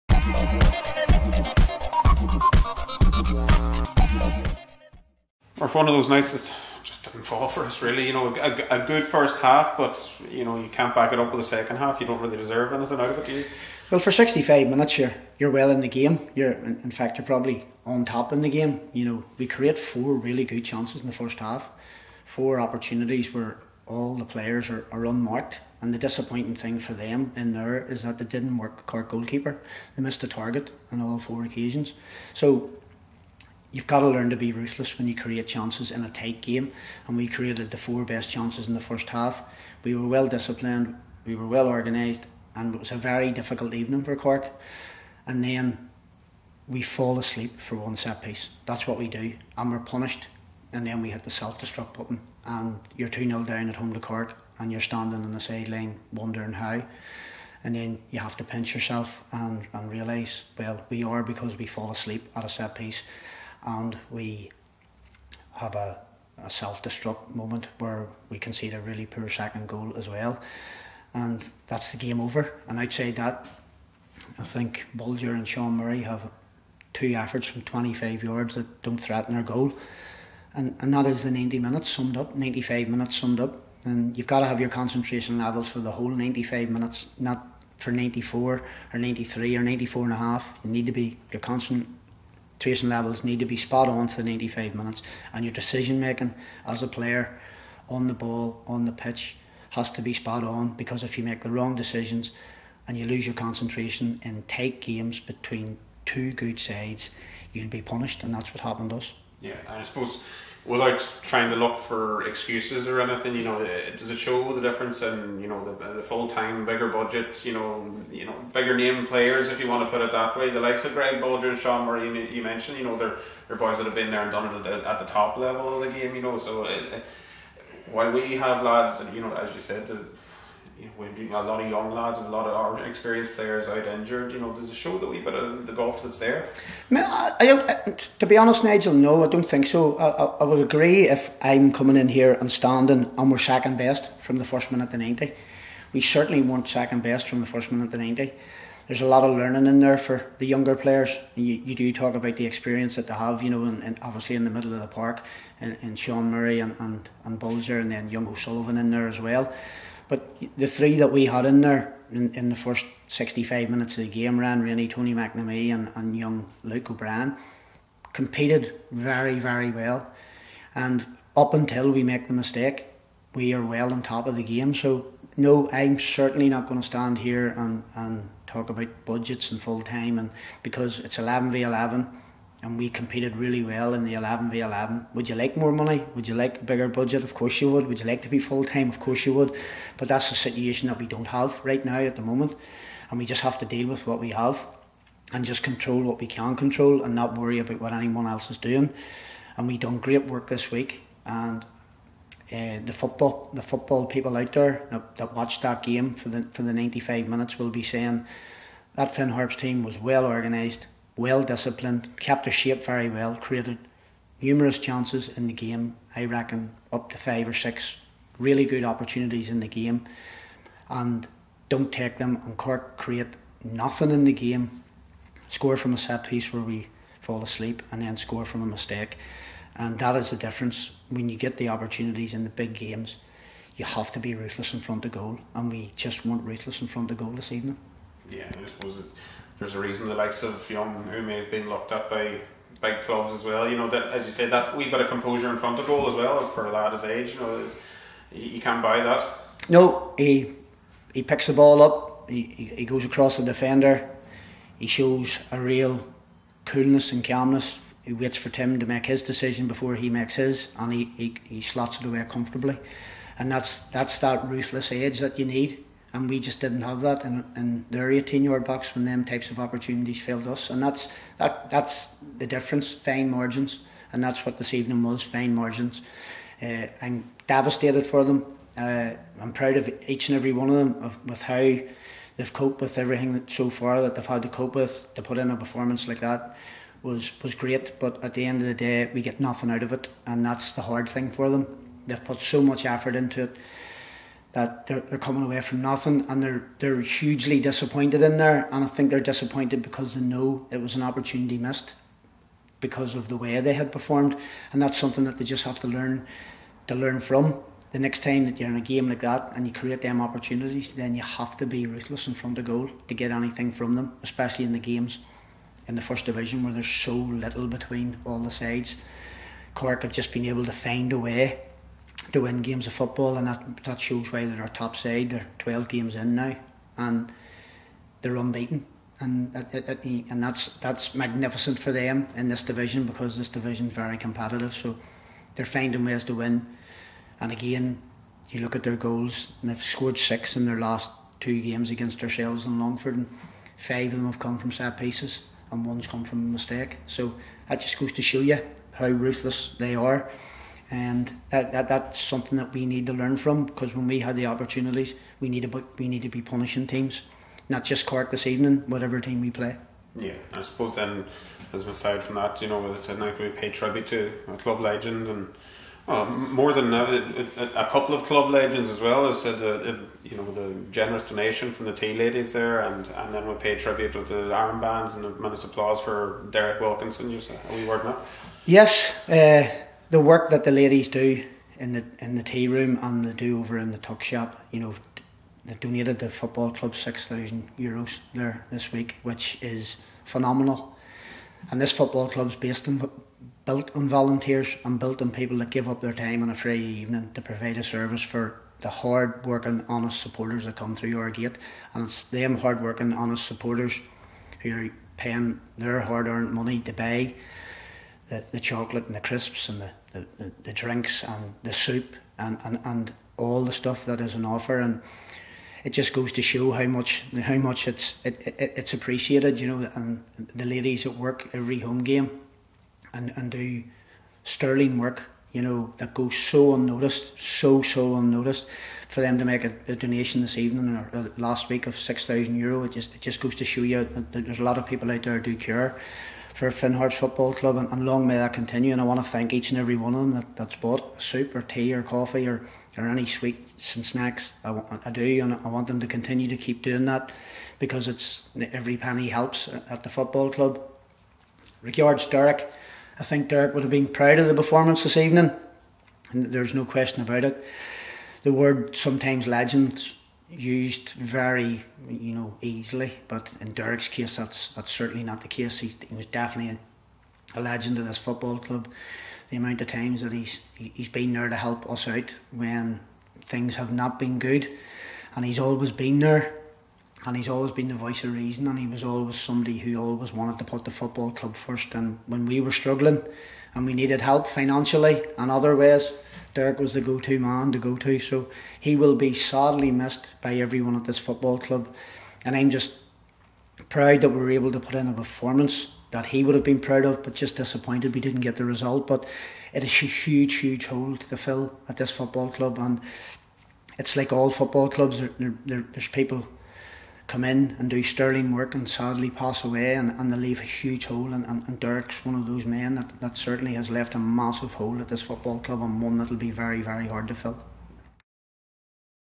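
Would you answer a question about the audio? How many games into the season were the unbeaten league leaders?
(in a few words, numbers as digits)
12.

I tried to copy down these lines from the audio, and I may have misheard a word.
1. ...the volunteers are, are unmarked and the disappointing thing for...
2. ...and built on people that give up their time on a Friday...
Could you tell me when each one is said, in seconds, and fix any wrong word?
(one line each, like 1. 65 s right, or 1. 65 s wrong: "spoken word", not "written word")
1. 24 s wrong: "players", not "volunteers"
2. 394 s right.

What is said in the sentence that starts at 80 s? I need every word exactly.
And, and that is the 90 minutes summed up, 95 minutes summed up.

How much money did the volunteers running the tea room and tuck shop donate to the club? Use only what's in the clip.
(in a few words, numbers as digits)
6000 euros.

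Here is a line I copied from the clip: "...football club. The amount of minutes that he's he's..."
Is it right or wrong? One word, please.
wrong.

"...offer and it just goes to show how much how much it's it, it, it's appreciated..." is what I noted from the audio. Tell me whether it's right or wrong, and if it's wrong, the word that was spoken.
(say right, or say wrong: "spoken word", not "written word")
right.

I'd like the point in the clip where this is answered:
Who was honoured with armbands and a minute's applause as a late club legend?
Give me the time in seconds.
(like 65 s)
376 s.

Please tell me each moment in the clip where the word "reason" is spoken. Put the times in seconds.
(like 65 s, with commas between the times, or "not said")
239 s, 478 s.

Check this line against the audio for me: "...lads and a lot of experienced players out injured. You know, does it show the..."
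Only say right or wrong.
right.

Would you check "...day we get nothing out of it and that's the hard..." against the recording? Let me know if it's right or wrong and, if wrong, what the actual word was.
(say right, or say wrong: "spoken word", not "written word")
right.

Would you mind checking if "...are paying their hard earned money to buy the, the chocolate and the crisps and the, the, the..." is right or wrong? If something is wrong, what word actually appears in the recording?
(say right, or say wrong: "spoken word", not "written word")
right.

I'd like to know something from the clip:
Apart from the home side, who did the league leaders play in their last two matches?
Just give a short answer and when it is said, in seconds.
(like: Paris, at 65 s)
Longford, at 342 s.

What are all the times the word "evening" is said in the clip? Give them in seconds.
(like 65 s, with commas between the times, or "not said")
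43 s, 237 s, 274 s, 358 s, 396 s, 430 s, 455 s.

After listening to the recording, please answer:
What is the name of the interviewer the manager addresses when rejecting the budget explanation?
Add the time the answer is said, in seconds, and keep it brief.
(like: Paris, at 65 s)
Nigel, at 138 s.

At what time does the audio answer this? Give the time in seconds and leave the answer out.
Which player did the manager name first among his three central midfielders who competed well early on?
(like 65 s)
164 s.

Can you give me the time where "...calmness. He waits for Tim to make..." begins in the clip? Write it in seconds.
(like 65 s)
257 s.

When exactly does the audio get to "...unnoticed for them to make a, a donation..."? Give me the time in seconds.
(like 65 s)
428 s.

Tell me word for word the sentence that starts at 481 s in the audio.
And when we were struggling, and we needed help financially and other ways.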